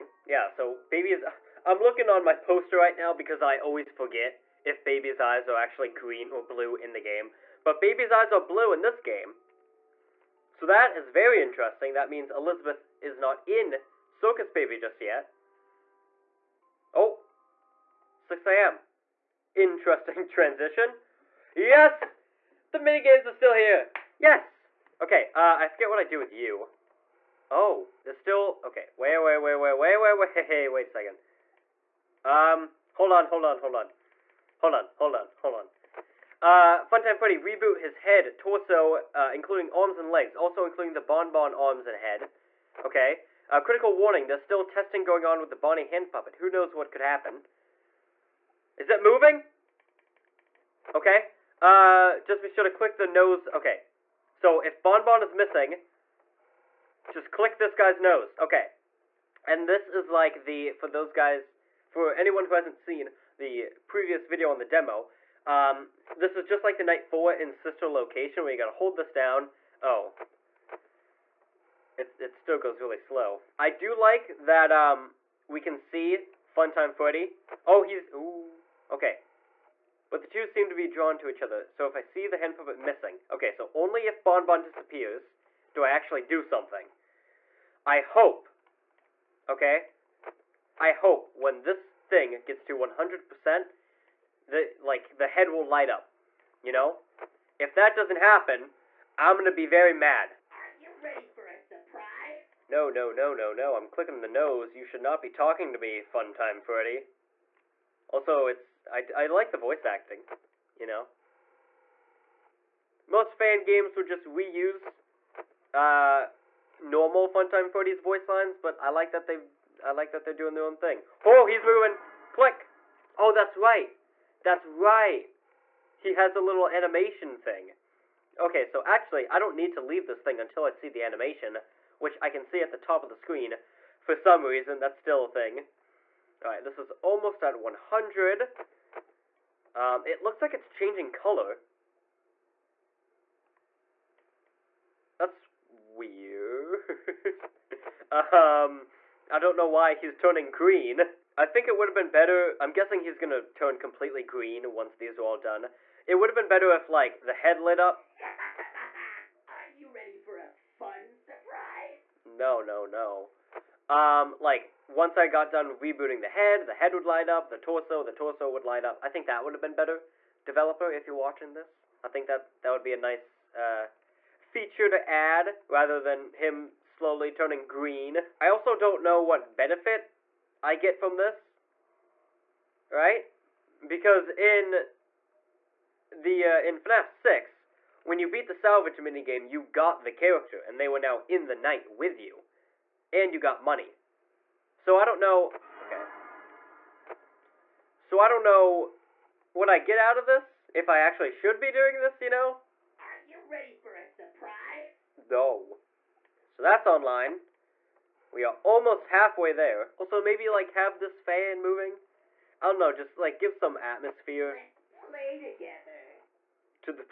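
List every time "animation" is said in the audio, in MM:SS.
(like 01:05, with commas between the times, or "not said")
02:06, 02:11.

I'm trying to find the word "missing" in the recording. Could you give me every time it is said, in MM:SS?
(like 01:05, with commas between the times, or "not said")
00:55, 01:22.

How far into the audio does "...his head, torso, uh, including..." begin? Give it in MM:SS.
00:37.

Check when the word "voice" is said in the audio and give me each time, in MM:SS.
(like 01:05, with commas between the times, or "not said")
01:49, 01:58.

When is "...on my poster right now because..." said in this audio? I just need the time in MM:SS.
00:02.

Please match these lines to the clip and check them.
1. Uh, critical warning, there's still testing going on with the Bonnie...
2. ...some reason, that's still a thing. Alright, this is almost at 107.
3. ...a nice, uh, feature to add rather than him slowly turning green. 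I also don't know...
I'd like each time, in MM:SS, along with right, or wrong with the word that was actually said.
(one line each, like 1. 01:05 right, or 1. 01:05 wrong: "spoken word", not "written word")
1. 00:43 right
2. 02:14 wrong: "100", not "107"
3. 02:52 right.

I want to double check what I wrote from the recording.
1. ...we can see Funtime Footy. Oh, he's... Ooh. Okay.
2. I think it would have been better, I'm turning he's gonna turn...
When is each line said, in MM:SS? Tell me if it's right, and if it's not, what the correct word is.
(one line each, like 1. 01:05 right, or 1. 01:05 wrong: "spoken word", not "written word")
1. 01:15 right
2. 02:31 wrong: "guessing", not "turning".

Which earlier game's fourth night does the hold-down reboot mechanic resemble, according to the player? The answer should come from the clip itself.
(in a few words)
Sister Location.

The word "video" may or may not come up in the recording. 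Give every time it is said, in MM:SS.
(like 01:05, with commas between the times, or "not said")
01:04.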